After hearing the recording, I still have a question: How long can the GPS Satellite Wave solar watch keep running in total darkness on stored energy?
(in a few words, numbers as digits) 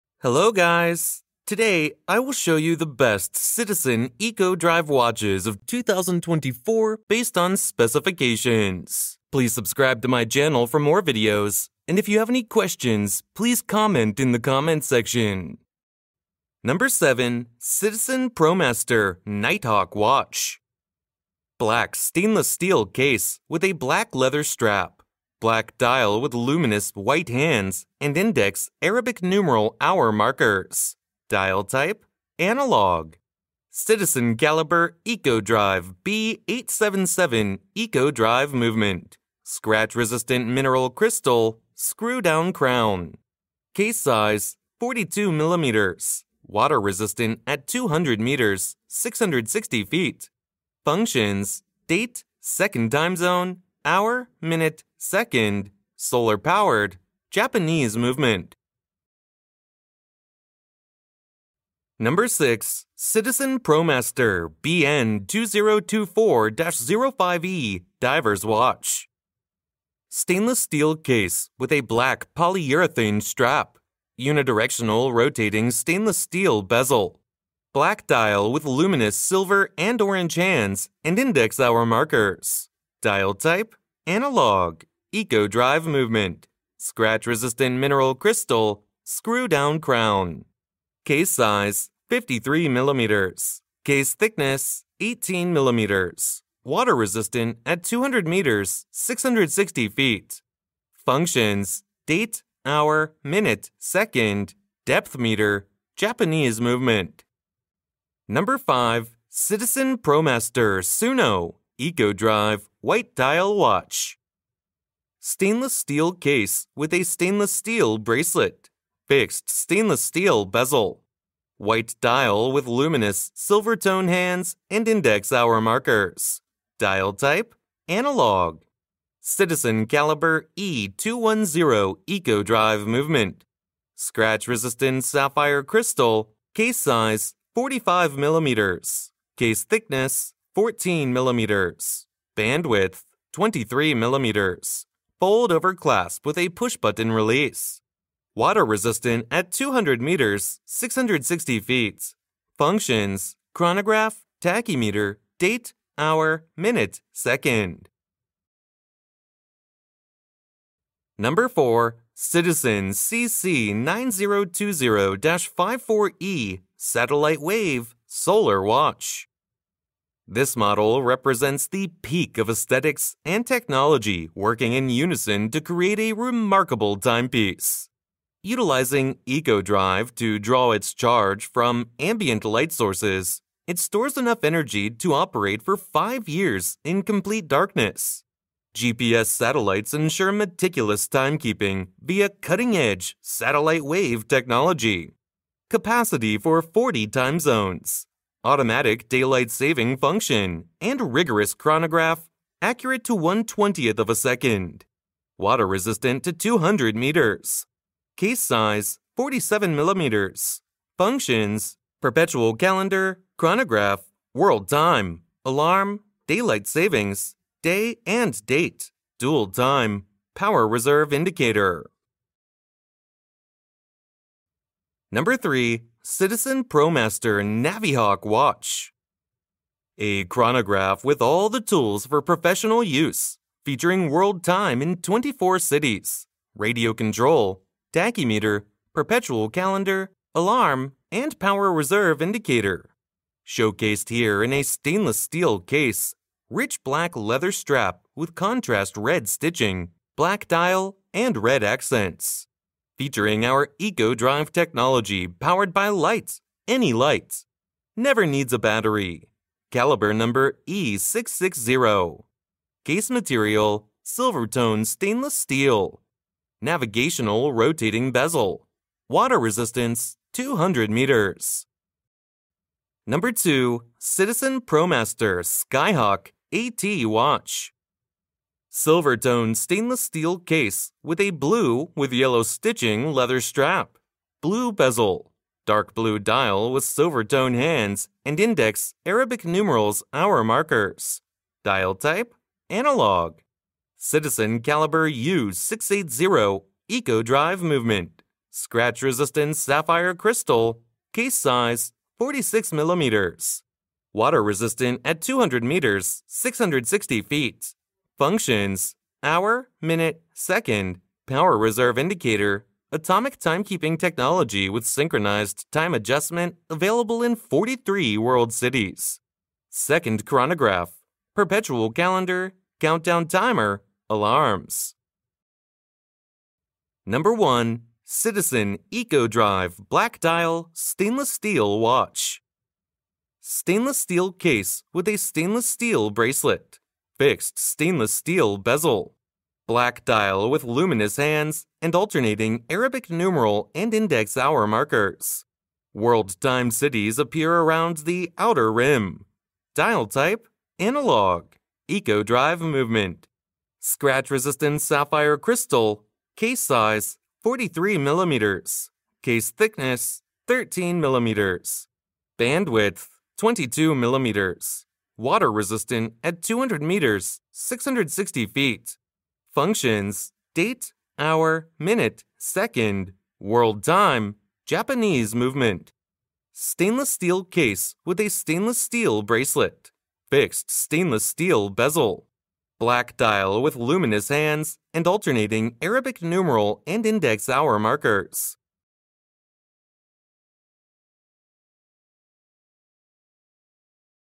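5 years.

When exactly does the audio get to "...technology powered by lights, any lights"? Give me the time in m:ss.
4:14.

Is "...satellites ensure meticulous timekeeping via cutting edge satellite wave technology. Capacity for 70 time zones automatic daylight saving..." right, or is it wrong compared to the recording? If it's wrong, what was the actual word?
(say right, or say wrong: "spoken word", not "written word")
wrong: "40", not "70".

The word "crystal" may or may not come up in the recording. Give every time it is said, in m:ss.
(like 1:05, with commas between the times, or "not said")
0:40, 1:28, 2:15, 5:00, 5:55.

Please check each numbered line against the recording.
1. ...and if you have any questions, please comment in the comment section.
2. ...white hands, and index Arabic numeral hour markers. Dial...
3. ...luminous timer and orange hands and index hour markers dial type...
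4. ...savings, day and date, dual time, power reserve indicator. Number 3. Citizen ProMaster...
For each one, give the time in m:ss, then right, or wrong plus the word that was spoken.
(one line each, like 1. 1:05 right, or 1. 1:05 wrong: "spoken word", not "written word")
1. 0:11 right
2. 0:26 right
3. 1:18 wrong: "silver", not "timer"
4. 3:36 right.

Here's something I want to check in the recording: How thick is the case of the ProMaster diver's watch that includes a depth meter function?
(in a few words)
18 millimeters.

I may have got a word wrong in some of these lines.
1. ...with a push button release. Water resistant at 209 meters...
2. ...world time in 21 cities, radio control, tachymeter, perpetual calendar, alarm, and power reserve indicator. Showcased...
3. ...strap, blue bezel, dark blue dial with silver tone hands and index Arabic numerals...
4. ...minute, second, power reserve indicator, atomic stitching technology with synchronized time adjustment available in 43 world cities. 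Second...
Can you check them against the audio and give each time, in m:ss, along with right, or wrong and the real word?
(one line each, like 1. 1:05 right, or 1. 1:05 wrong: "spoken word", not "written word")
1. 2:26 wrong: "200", not "209"
2. 3:54 wrong: "24", not "21"
3. 4:43 right
4. 5:09 wrong: "timekeeping", not "stitching".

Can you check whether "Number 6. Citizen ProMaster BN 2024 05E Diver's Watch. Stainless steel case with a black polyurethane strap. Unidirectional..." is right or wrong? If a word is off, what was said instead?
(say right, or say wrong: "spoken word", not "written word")
right.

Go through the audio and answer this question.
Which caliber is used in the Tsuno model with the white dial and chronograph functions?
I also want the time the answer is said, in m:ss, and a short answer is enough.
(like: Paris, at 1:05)
E210, at 2:10.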